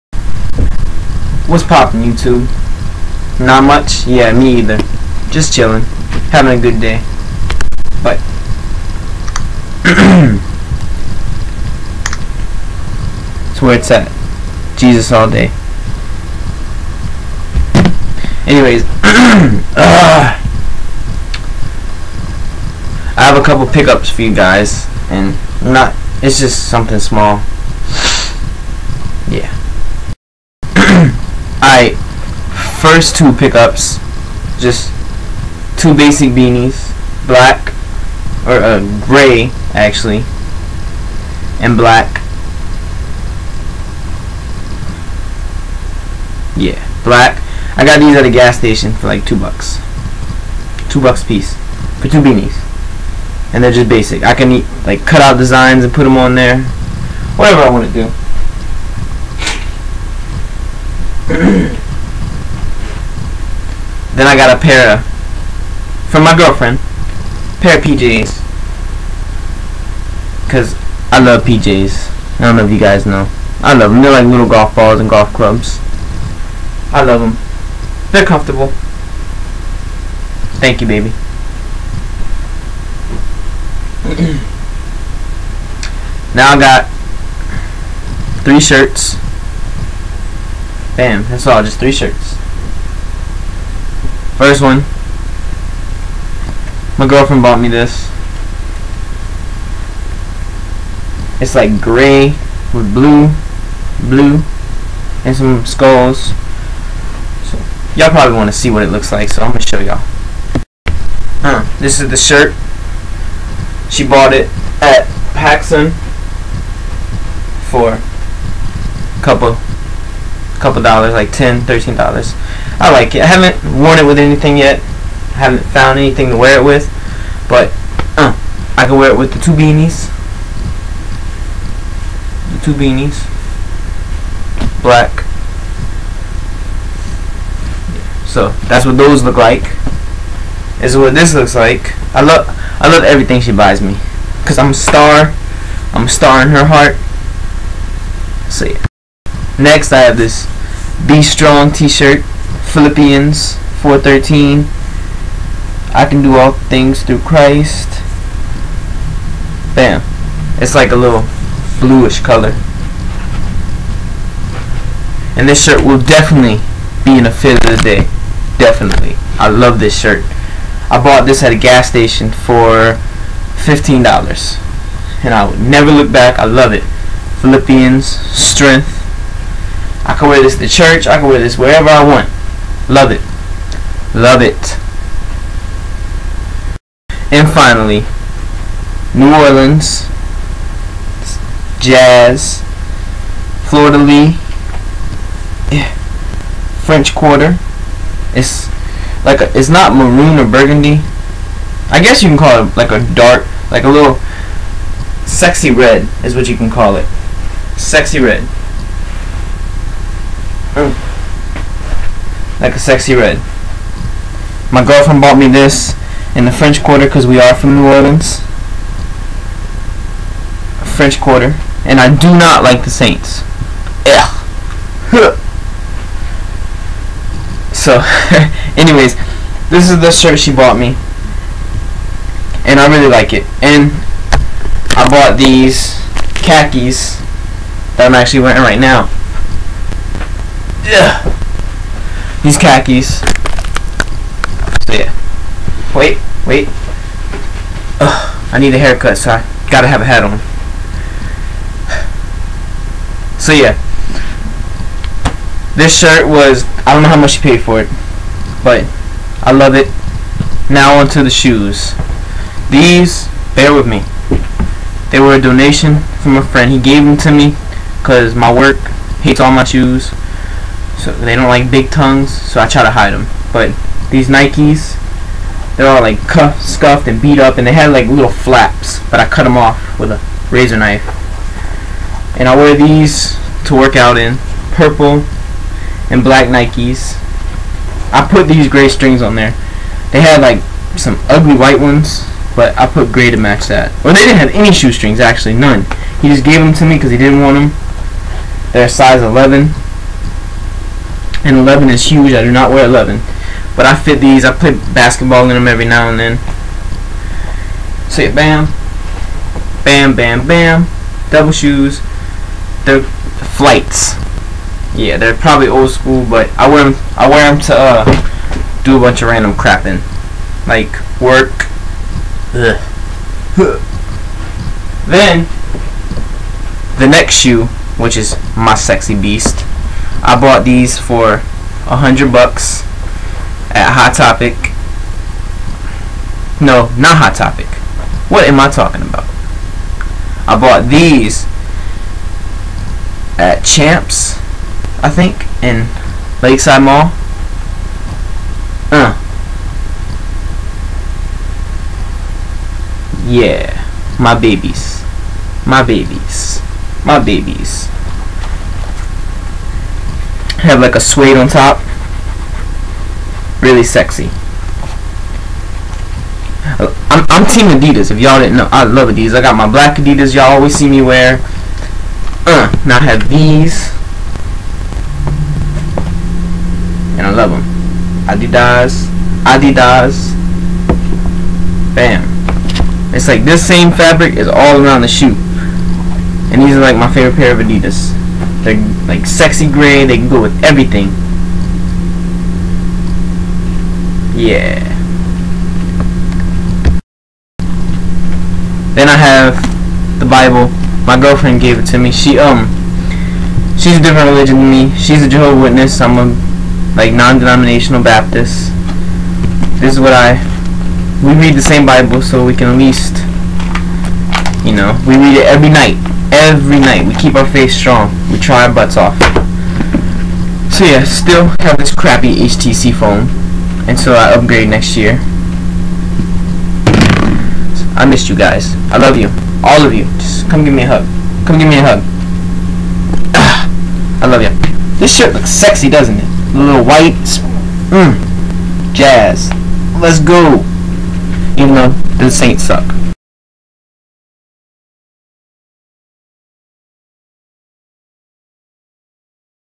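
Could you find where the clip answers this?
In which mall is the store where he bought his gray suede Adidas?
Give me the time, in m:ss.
5:46.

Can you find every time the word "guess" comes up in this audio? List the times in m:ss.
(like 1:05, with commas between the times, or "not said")
3:22.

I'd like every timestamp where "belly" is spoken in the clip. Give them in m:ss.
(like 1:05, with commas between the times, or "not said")
not said.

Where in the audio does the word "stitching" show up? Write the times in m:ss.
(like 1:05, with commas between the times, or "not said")
not said.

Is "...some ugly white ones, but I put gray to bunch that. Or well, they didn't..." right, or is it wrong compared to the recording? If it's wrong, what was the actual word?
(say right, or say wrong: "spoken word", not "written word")
wrong: "match", not "bunch".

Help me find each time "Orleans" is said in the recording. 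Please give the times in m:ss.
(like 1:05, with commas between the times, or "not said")
3:09, 3:37.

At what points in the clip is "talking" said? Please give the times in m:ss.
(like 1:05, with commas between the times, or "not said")
5:38.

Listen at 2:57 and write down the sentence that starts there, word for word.
Philippians, strength, I can wear this to church.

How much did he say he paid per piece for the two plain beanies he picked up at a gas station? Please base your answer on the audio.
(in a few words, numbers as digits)
$2.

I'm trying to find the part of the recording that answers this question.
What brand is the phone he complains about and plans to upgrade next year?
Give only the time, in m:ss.
7:02.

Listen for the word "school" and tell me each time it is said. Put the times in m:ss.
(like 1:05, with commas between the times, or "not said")
5:15.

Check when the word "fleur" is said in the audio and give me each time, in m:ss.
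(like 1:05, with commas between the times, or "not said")
3:13.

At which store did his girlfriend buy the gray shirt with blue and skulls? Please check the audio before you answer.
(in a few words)
PacSun.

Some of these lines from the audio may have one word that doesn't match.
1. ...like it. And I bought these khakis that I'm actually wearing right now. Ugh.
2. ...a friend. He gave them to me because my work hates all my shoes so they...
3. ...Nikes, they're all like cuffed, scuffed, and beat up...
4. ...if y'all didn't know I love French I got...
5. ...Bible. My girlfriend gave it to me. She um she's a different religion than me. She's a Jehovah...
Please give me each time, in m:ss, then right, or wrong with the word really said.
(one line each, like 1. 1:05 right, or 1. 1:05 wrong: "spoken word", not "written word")
1. 3:53 right
2. 4:26 right
3. 4:34 right
4. 6:08 wrong: "Adidas", not "French"
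5. 6:40 right.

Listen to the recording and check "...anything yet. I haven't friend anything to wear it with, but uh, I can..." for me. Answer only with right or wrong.
wrong.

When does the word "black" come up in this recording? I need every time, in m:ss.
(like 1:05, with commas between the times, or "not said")
0:37, 0:41, 0:47, 2:14, 4:46, 6:09.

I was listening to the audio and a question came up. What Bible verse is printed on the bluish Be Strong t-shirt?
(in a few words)
Philippians 4:13.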